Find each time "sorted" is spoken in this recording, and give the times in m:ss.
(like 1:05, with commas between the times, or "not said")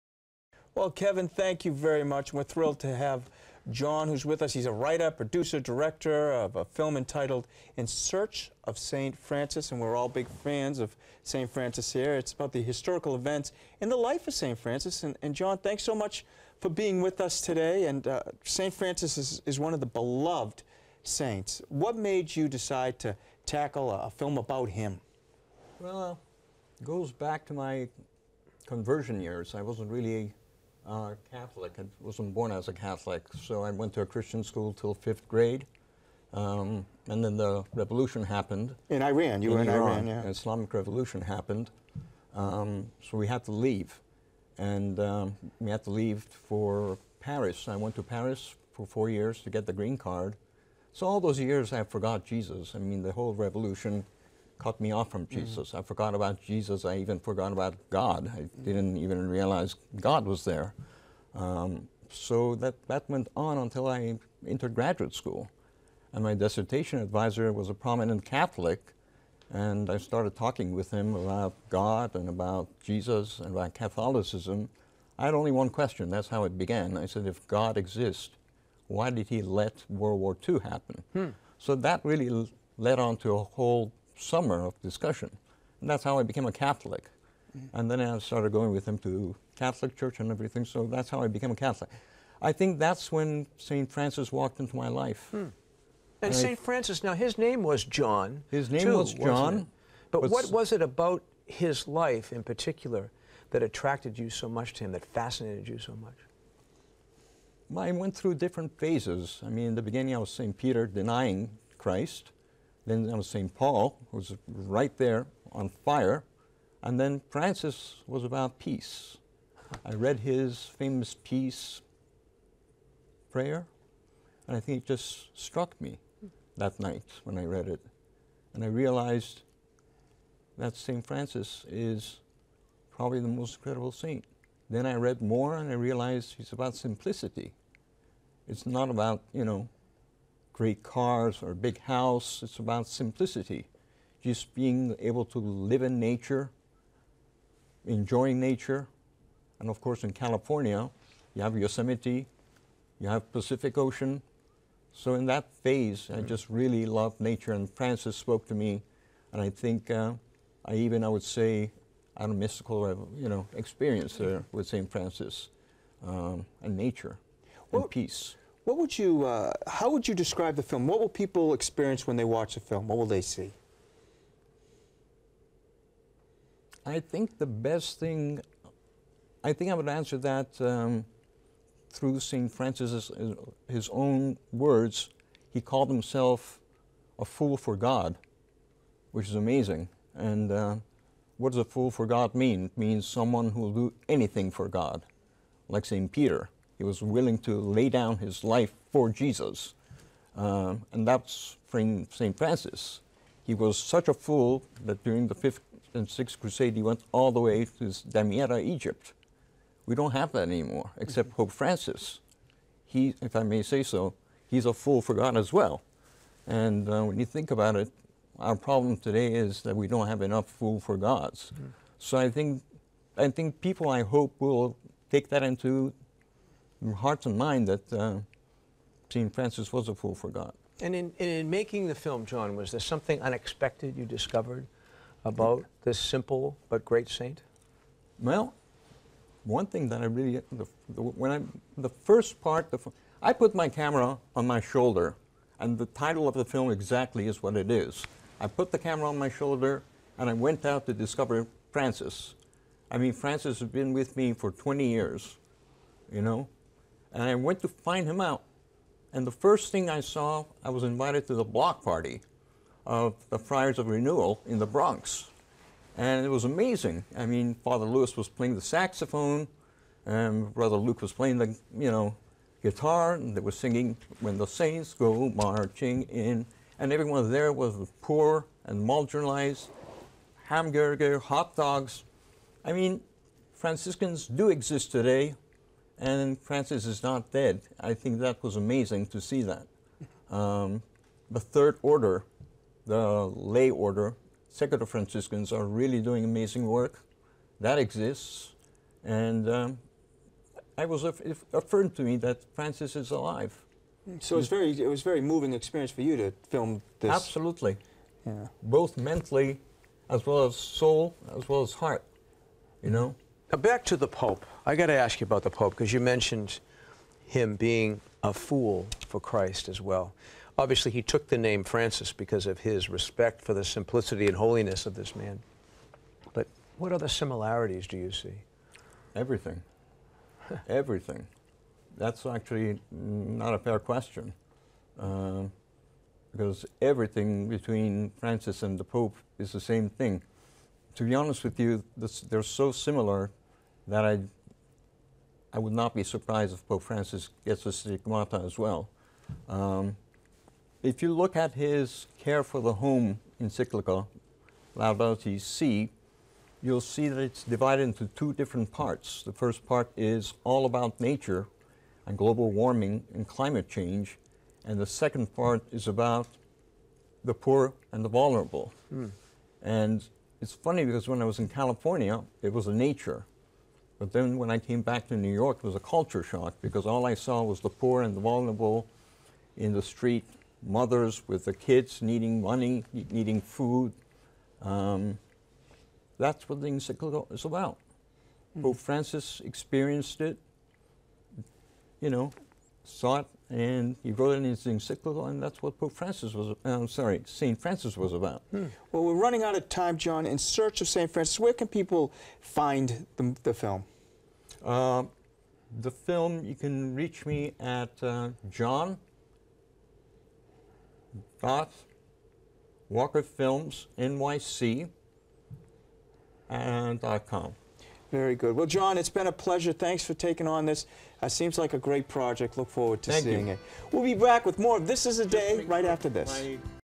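not said.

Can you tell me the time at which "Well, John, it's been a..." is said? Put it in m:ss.
6:58.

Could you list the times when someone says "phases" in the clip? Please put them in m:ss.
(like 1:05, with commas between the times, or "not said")
1:48, 2:35.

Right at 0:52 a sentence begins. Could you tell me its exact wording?
I mean, the whole revolution, cut me off from mm.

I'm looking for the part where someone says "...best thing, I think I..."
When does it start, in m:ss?
2:57.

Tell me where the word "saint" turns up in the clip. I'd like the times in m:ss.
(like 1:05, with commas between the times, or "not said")
0:21, 2:13, 3:57, 4:34.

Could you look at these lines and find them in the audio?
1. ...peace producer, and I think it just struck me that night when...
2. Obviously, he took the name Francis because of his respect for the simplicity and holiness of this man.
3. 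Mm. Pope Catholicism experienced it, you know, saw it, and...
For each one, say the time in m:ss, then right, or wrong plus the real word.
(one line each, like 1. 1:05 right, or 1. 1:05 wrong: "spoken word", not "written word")
1. 2:01 wrong: "prayer", not "producer"
2. 5:20 right
3. 6:28 wrong: "Francis", not "Catholicism".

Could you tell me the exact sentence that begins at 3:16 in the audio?
He was willing to lay down his life for Jesus.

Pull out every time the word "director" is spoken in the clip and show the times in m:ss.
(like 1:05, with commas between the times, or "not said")
0:05.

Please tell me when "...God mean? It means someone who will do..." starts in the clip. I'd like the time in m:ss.
3:12.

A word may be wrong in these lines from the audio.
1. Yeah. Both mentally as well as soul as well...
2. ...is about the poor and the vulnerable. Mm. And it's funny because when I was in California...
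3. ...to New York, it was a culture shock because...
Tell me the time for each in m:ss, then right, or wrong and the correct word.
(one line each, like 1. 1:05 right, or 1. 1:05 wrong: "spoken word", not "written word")
1. 5:08 right
2. 6:05 right
3. 6:15 right.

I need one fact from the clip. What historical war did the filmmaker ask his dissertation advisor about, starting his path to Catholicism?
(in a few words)
World War II.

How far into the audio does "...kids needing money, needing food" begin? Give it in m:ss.
6:21.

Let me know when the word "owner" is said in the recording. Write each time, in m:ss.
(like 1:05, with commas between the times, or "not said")
not said.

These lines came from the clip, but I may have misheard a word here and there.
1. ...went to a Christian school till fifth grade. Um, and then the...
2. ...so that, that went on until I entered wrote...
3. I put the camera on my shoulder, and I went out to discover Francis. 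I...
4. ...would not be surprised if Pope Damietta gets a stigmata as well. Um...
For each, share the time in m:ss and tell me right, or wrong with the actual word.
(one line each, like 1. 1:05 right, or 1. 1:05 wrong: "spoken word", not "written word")
1. 0:33 right
2. 1:02 wrong: "graduate", not "wrote"
3. 4:08 right
4. 5:45 wrong: "Francis", not "Damietta".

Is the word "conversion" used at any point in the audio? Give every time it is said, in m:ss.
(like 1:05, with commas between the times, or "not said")
0:28.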